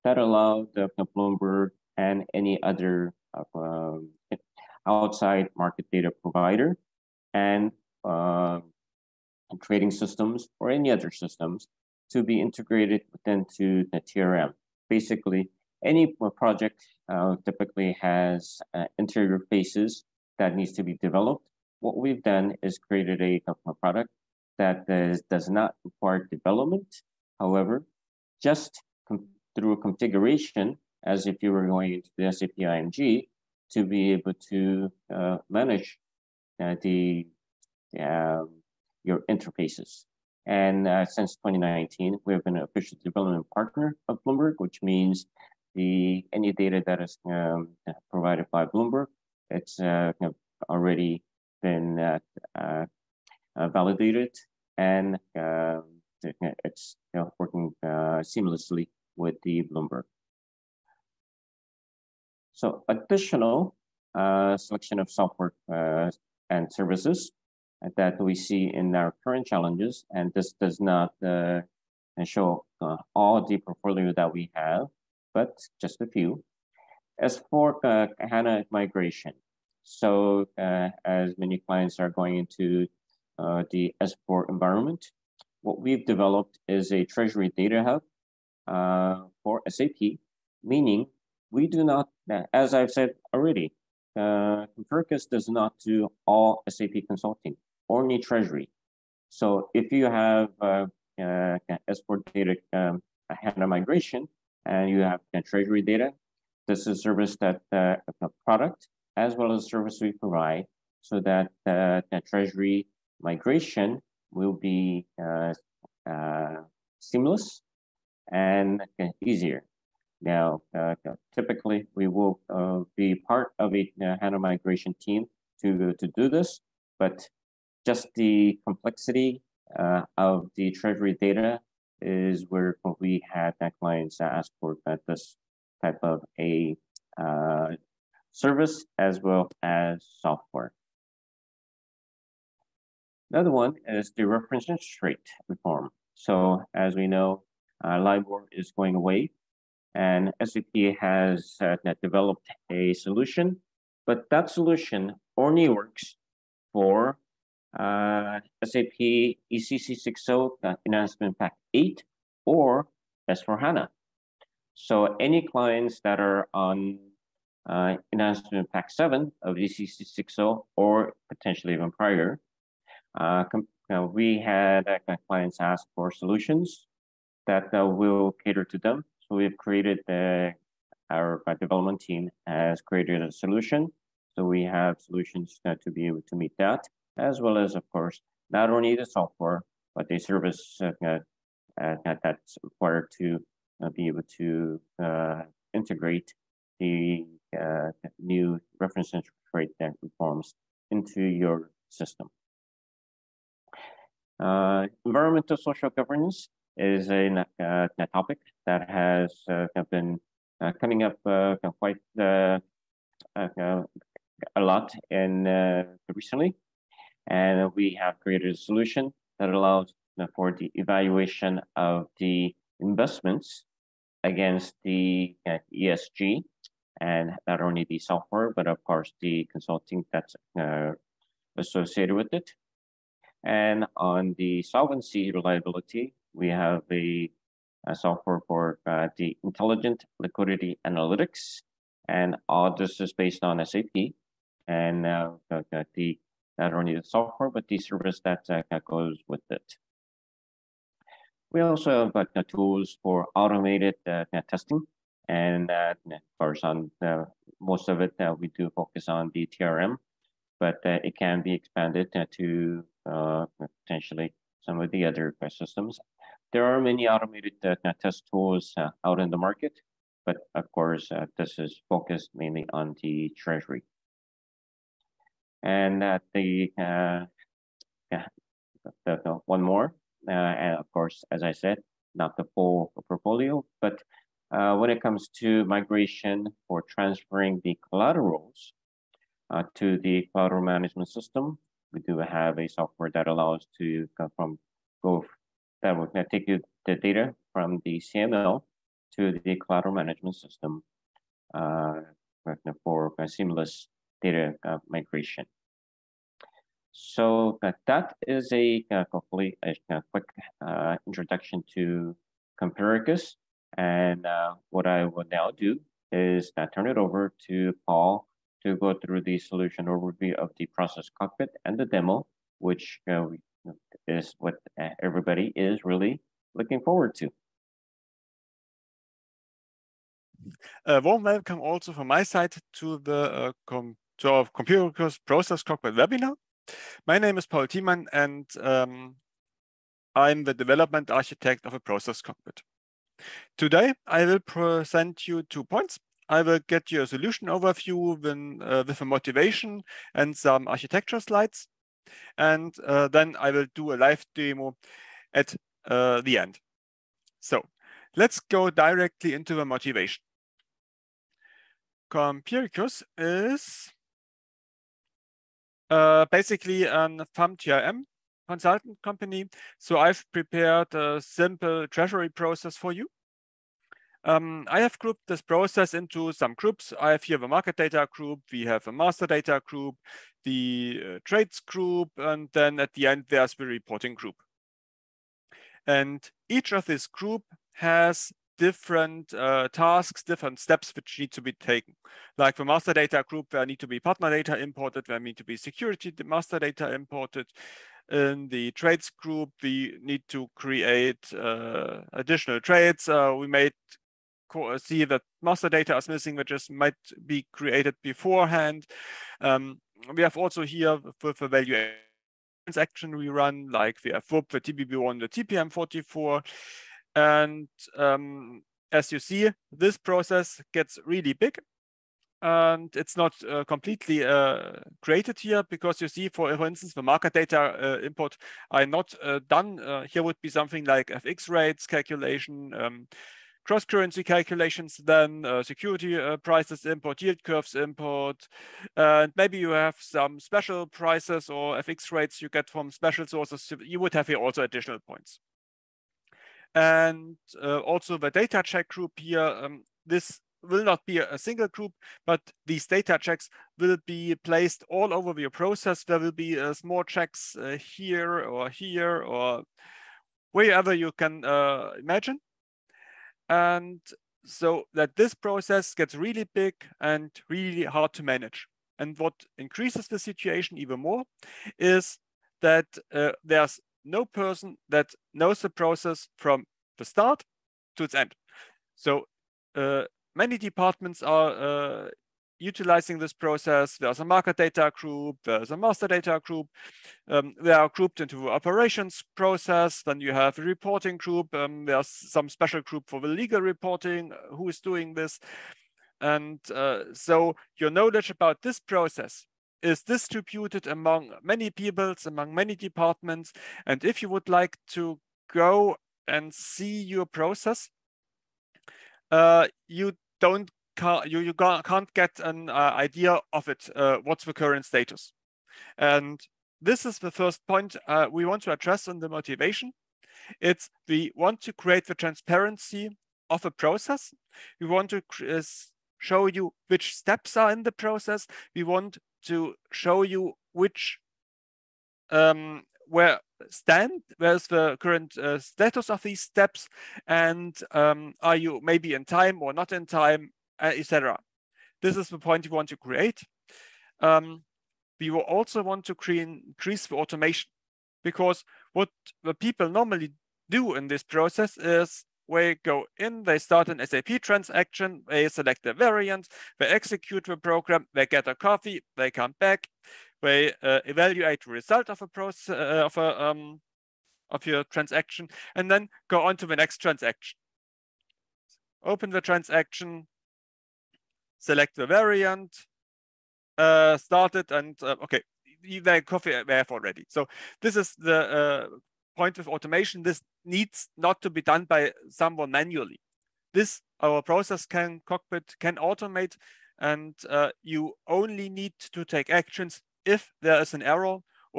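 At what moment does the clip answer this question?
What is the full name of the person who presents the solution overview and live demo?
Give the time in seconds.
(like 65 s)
337 s.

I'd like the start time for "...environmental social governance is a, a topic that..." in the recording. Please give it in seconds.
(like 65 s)
205 s.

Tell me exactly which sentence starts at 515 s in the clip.
And this is the first point uh, we want to address on the motivation.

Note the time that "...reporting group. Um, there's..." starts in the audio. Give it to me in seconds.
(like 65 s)
490 s.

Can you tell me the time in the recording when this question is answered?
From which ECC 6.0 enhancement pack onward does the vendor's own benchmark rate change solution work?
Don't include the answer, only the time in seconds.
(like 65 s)
160 s.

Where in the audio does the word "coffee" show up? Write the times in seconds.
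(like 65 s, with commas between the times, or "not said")
558 s, 576 s.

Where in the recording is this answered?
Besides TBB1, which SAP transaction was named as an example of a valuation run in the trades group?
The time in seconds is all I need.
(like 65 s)
415 s.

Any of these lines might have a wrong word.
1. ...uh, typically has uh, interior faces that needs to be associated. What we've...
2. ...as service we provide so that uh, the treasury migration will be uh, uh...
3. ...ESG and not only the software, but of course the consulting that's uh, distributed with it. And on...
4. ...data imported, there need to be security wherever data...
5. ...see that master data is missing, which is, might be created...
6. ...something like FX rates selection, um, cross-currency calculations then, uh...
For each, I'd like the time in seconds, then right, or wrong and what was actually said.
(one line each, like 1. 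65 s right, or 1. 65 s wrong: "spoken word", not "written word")
1. 17 s wrong: "developed", not "associated"
2. 109 s right
3. 225 s wrong: "associated", not "distributed"
4. 394 s wrong: "master", not "wherever"
5. 404 s right
6. 430 s wrong: "calculation", not "selection".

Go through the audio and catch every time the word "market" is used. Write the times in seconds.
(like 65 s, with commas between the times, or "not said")
5 s, 269 s, 377 s, 427 s, 484 s.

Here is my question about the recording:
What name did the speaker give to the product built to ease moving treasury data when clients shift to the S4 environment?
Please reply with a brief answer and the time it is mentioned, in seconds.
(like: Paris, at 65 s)
treasury data hub, at 87 s.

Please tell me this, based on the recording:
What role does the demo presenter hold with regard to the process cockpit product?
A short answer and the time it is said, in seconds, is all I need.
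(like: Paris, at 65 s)
development architect, at 340 s.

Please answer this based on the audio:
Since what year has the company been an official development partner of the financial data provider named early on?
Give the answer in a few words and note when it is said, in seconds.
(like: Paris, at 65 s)
2019, at 41 s.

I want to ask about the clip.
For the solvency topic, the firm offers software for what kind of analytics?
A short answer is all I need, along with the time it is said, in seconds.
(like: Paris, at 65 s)
intelligent liquidity analytics, at 239 s.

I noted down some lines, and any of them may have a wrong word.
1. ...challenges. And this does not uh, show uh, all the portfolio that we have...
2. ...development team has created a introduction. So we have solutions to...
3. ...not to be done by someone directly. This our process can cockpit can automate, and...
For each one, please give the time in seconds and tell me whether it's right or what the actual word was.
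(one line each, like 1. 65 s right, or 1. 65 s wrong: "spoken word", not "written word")
1. 69 s right
2. 181 s wrong: "solution", not "introduction"
3. 581 s wrong: "manually", not "directly".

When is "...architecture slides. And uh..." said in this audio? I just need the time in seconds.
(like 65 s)
350 s.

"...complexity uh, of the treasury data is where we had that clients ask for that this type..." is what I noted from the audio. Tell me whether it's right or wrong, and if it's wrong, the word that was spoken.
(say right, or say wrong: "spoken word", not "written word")
right.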